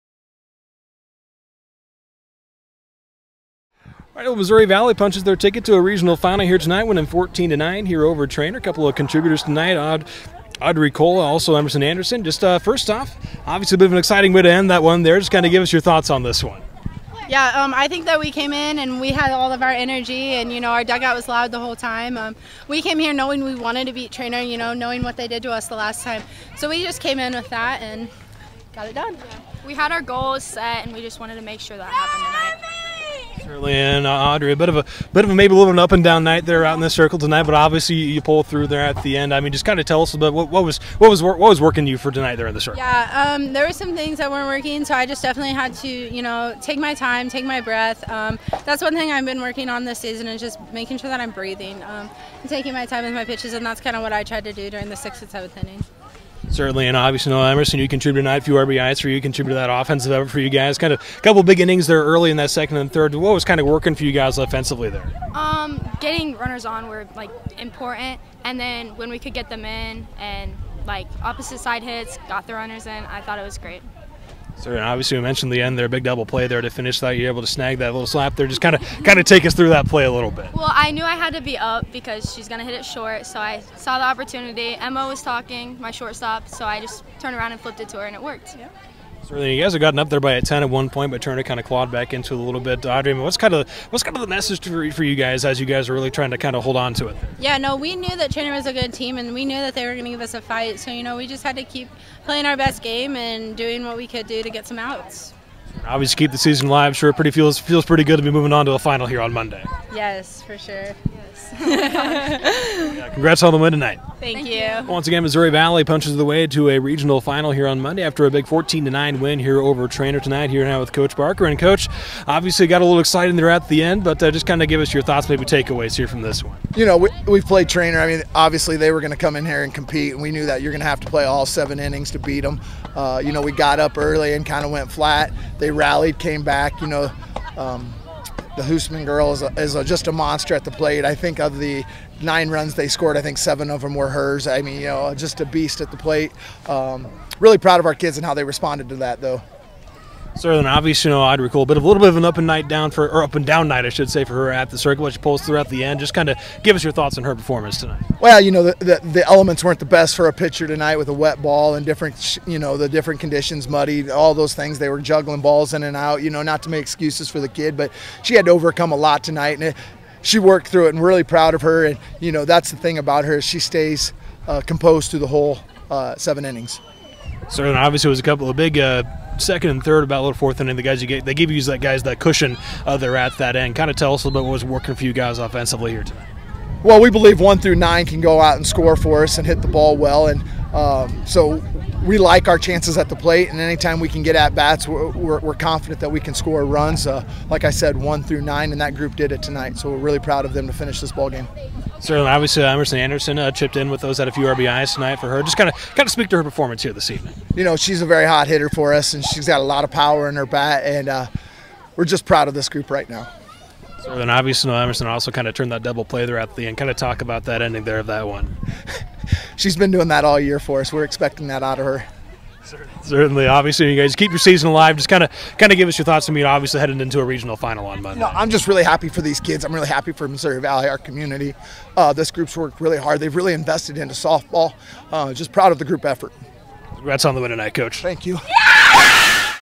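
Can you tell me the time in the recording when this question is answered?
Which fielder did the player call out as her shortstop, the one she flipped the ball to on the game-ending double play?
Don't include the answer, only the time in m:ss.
1:24.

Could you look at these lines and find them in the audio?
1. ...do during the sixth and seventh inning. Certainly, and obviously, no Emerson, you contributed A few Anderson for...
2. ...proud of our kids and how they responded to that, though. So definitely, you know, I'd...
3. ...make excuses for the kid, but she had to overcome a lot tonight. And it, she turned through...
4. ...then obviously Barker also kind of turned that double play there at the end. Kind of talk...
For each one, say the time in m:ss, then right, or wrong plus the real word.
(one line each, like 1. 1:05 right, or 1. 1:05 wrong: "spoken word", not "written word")
1. 0:54 wrong: "RBIs", not "Anderson"
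2. 2:27 wrong: "obviously", not "definitely"
3. 2:46 wrong: "worked", not "turned"
4. 3:34 wrong: "Emerson", not "Barker".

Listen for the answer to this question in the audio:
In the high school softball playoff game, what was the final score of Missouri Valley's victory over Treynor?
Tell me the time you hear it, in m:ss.
0:07.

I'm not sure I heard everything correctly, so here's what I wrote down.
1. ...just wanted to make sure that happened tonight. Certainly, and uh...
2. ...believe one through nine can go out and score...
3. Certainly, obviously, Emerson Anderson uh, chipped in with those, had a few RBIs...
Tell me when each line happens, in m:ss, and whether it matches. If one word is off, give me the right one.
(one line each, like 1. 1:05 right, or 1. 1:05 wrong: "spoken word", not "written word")
1. 0:31 right
2. 3:07 right
3. 3:22 right.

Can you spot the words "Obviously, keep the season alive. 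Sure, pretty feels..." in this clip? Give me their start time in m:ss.
1:45.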